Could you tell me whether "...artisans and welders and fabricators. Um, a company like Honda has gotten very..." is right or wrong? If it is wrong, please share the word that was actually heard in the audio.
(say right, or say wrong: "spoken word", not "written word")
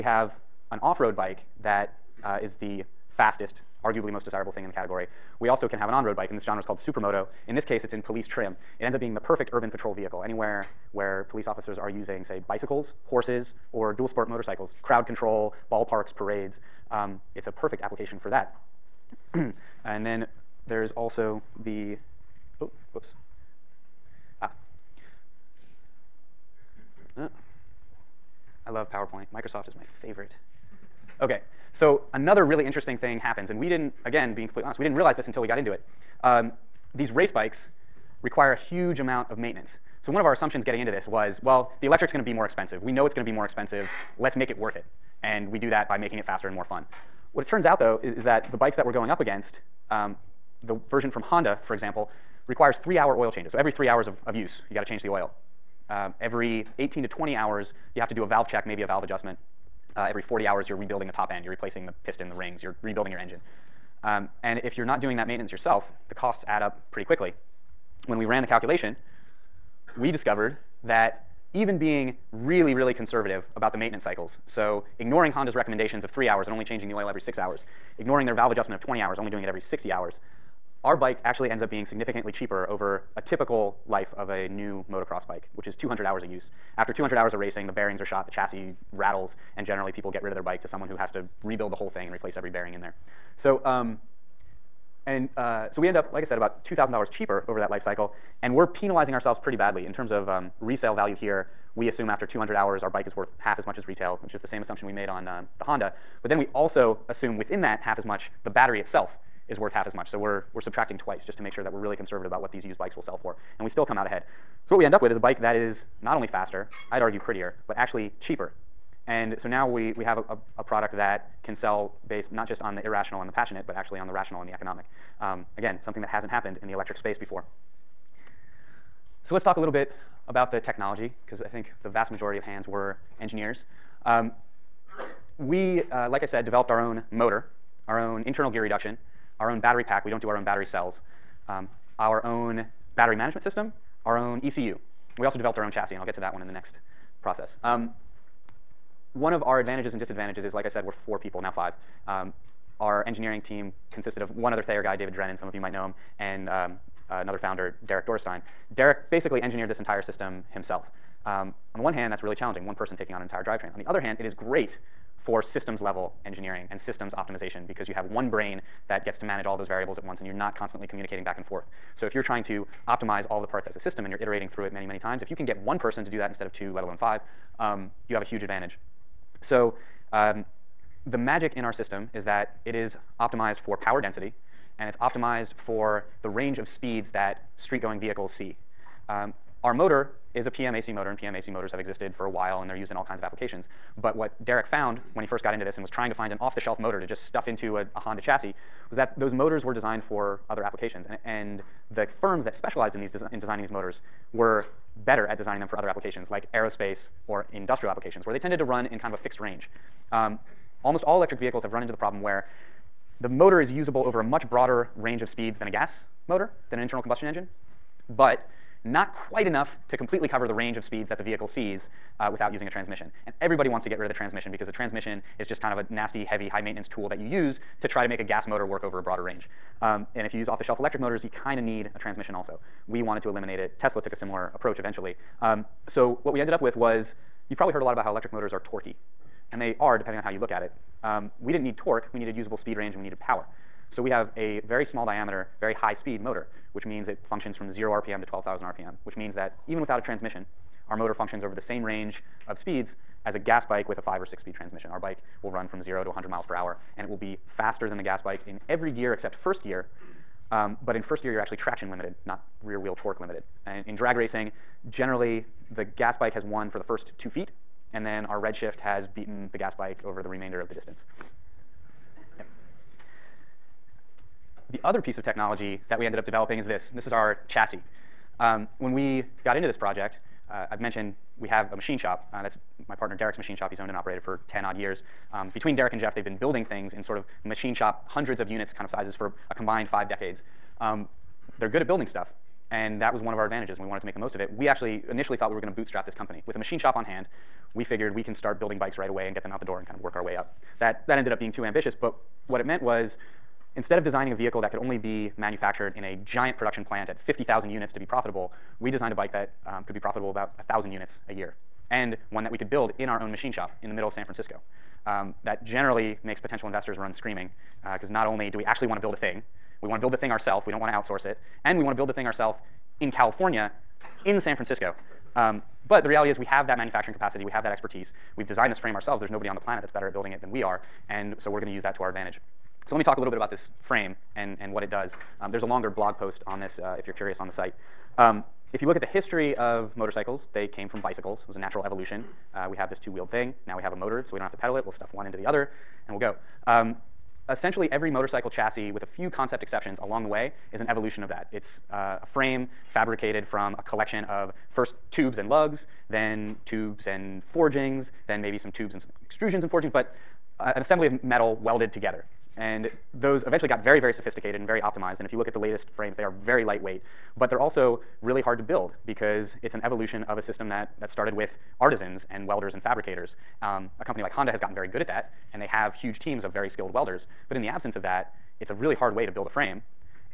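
right.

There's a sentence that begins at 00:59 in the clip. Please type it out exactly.
Uh, every 40 hours, you're rebuilding the top end, you're replacing the piston, the rings, you're rebuilding your engine.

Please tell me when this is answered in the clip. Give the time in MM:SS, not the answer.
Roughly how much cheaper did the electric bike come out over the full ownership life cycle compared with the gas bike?
01:36.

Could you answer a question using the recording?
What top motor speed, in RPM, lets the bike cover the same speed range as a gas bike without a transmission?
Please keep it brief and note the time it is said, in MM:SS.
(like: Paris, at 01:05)
12,000 RPM, at 04:08.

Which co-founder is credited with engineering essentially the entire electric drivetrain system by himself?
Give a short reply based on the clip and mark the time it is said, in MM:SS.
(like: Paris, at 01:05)
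Derek Dorresteyn, at 02:37.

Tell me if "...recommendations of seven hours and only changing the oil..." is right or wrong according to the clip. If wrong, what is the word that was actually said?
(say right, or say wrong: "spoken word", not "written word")
wrong: "three", not "seven".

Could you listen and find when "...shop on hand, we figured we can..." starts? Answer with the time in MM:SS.
04:56.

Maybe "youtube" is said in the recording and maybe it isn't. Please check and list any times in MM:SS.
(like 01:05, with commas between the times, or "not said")
not said.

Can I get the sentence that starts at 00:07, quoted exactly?
In this case, it's in police trim.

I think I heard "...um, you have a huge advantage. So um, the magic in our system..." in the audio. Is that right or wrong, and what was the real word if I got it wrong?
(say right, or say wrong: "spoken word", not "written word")
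right.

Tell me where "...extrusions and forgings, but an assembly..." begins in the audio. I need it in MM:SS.
05:59.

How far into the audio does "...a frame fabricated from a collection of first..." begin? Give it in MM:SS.
05:52.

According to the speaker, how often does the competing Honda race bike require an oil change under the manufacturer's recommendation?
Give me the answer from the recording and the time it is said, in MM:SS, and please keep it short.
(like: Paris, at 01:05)
3 hours, at 00:52.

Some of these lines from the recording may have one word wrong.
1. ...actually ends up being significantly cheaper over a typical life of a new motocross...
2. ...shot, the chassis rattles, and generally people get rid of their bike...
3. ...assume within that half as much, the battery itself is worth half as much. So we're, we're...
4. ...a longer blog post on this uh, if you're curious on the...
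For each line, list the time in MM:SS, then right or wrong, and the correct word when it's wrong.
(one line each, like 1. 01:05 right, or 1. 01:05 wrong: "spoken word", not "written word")
1. 01:21 right
2. 01:28 right
3. 01:47 right
4. 05:35 right.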